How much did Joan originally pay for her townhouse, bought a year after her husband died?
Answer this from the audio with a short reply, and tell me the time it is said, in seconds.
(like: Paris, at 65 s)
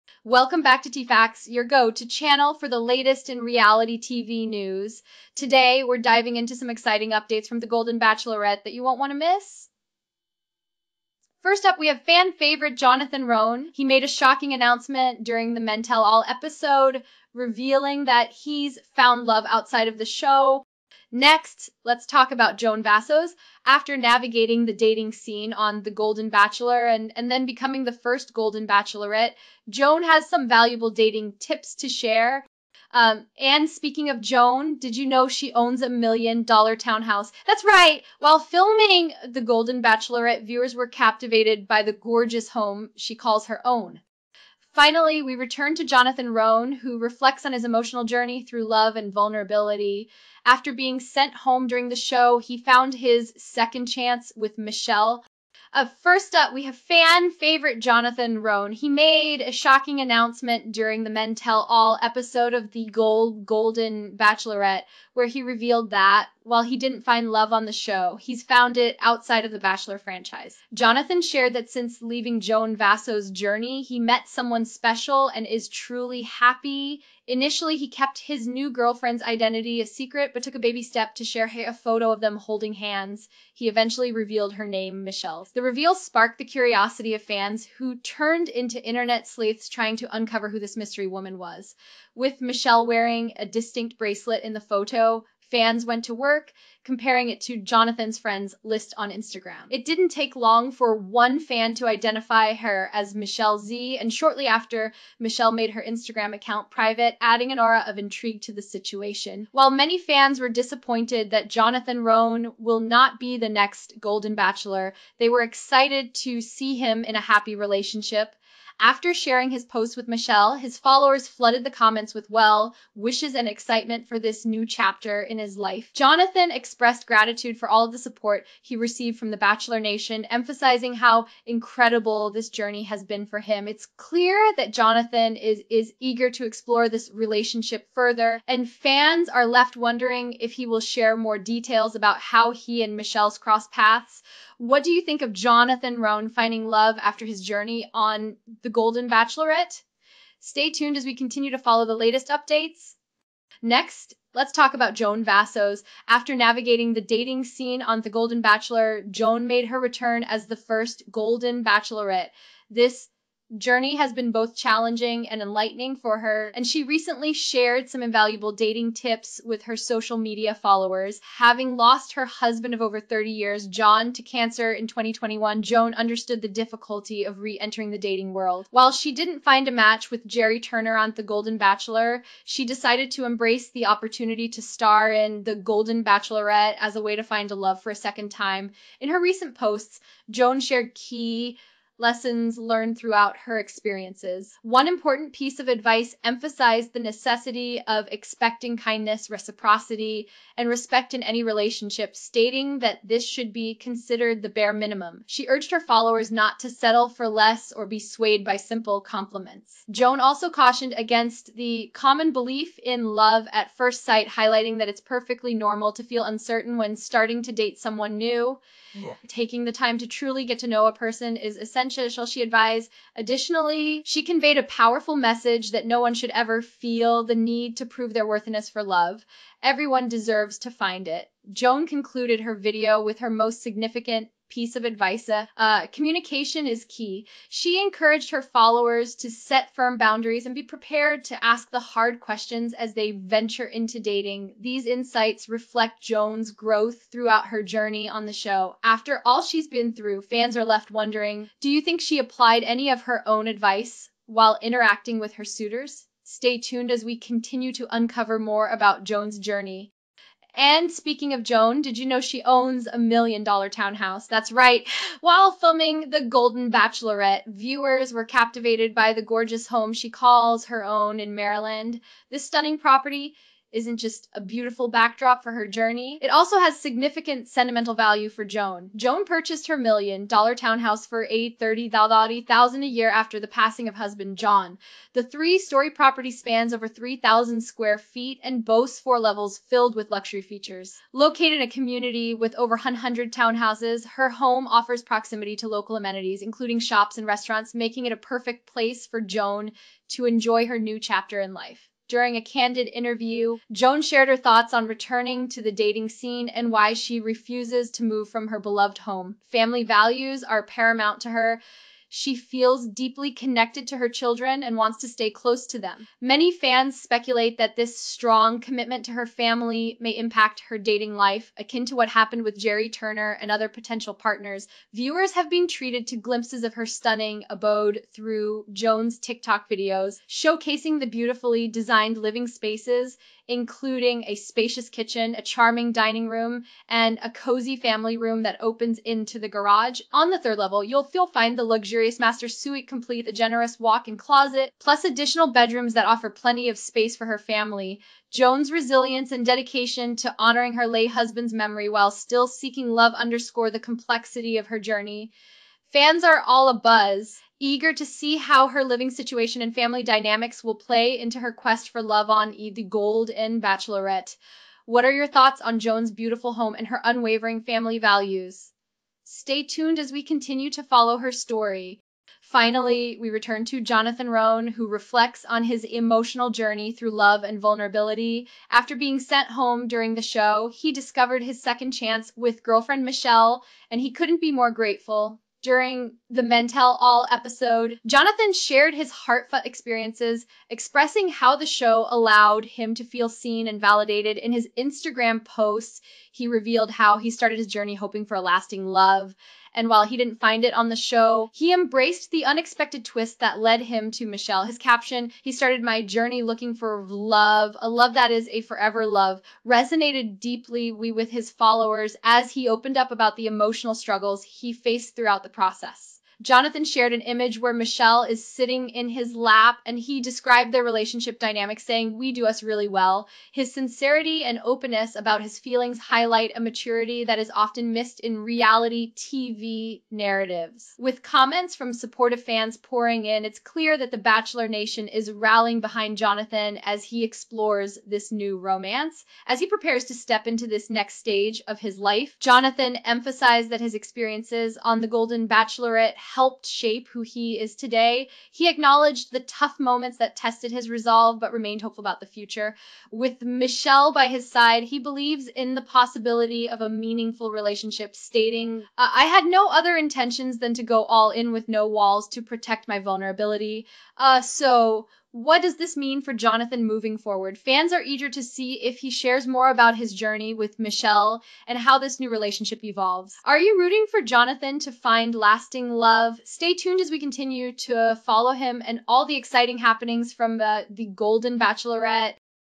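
830,000, at 281 s.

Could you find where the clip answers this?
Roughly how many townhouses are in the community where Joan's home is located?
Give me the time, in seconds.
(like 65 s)
292 s.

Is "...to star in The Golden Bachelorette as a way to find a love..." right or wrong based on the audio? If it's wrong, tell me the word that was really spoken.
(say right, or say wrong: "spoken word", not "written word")
right.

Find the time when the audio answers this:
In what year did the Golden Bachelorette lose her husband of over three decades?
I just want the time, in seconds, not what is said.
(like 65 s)
174 s.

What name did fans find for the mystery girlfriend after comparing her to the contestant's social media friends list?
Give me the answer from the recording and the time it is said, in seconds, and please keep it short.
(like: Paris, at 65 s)
Michelle Z, at 103 s.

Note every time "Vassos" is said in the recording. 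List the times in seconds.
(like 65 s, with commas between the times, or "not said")
22 s, 72 s, 155 s.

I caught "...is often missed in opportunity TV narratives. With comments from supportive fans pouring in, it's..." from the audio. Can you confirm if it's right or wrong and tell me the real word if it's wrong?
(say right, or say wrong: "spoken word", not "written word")
wrong: "reality", not "opportunity".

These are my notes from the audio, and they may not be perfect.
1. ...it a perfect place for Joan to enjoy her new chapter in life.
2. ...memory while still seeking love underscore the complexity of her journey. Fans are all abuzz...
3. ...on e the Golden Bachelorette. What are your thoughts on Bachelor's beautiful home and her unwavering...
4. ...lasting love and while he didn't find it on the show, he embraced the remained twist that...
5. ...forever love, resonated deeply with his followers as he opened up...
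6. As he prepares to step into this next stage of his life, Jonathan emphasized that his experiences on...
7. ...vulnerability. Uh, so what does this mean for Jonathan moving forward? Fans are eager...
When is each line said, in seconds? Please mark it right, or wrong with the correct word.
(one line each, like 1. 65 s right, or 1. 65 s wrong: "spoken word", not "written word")
1. 298 s right
2. 351 s right
3. 362 s wrong: "Joan", not "Bachelor"
4. 398 s wrong: "unexpected", not "remained"
5. 408 s right
6. 439 s right
7. 462 s right.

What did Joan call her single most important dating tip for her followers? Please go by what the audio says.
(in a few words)
communication is key.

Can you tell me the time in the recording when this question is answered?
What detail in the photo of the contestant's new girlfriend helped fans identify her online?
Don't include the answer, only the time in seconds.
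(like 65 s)
93 s.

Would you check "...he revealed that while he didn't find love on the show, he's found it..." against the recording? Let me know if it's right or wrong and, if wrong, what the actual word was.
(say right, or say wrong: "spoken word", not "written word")
right.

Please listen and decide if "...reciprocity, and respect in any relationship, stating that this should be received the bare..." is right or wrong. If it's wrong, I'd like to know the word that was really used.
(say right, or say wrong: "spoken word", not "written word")
wrong: "considered", not "received".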